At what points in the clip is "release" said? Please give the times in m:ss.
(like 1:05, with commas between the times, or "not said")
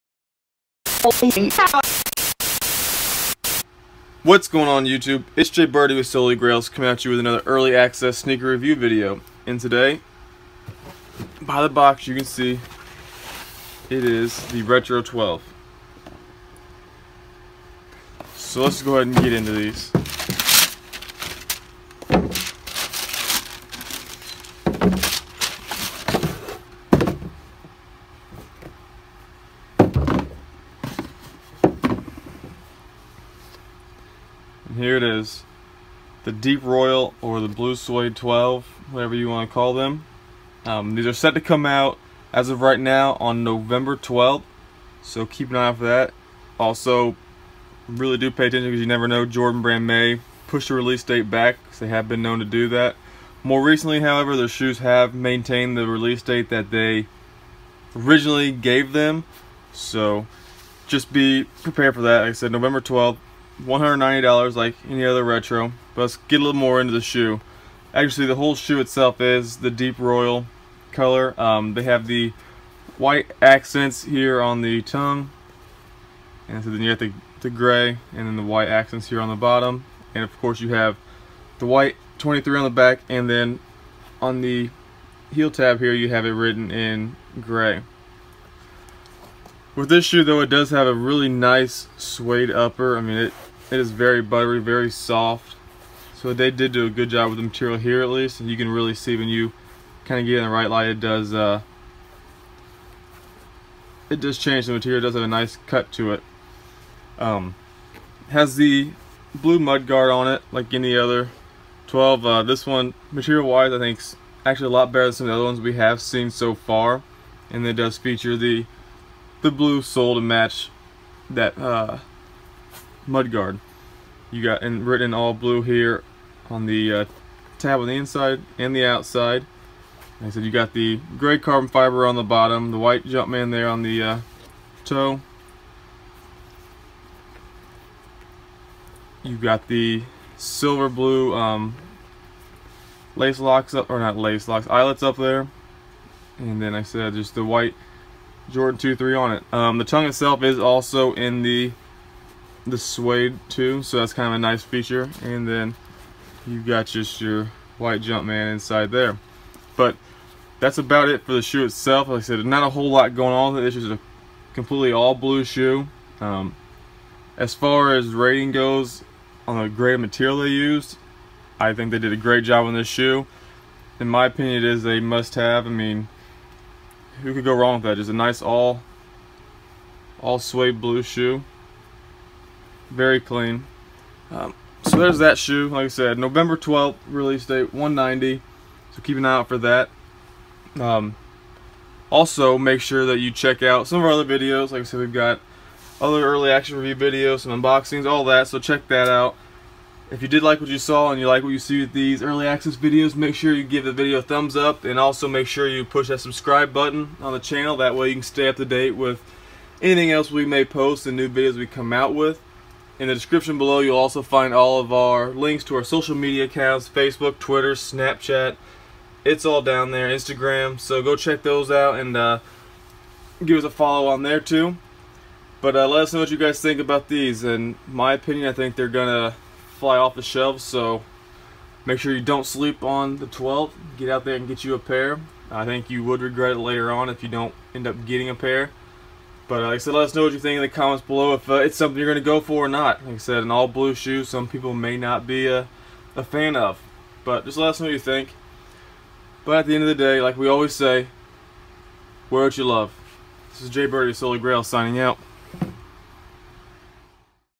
0:50, 0:55, 3:07.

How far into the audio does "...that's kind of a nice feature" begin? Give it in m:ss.
2:33.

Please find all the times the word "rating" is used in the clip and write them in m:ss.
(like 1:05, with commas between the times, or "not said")
2:48.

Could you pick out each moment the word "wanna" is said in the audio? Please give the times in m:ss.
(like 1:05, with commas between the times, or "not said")
not said.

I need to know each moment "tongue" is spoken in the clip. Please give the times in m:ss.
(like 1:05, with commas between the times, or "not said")
1:14, 2:29.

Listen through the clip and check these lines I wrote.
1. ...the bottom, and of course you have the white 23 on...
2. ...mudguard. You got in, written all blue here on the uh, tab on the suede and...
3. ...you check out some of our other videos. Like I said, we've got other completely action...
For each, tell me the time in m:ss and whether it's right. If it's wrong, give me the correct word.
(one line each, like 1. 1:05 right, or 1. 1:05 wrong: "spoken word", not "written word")
1. 1:19 right
2. 2:03 wrong: "inside", not "suede"
3. 3:13 wrong: "early", not "completely".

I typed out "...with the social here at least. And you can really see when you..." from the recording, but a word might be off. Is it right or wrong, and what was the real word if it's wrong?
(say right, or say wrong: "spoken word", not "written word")
wrong: "material", not "social".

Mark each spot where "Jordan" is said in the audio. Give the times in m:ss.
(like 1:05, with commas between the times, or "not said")
0:49, 2:28.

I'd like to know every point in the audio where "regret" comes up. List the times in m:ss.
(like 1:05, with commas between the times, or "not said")
3:56.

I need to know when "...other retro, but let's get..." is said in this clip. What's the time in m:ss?
1:05.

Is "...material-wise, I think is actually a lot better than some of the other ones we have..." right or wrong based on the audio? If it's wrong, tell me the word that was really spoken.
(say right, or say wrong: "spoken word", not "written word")
right.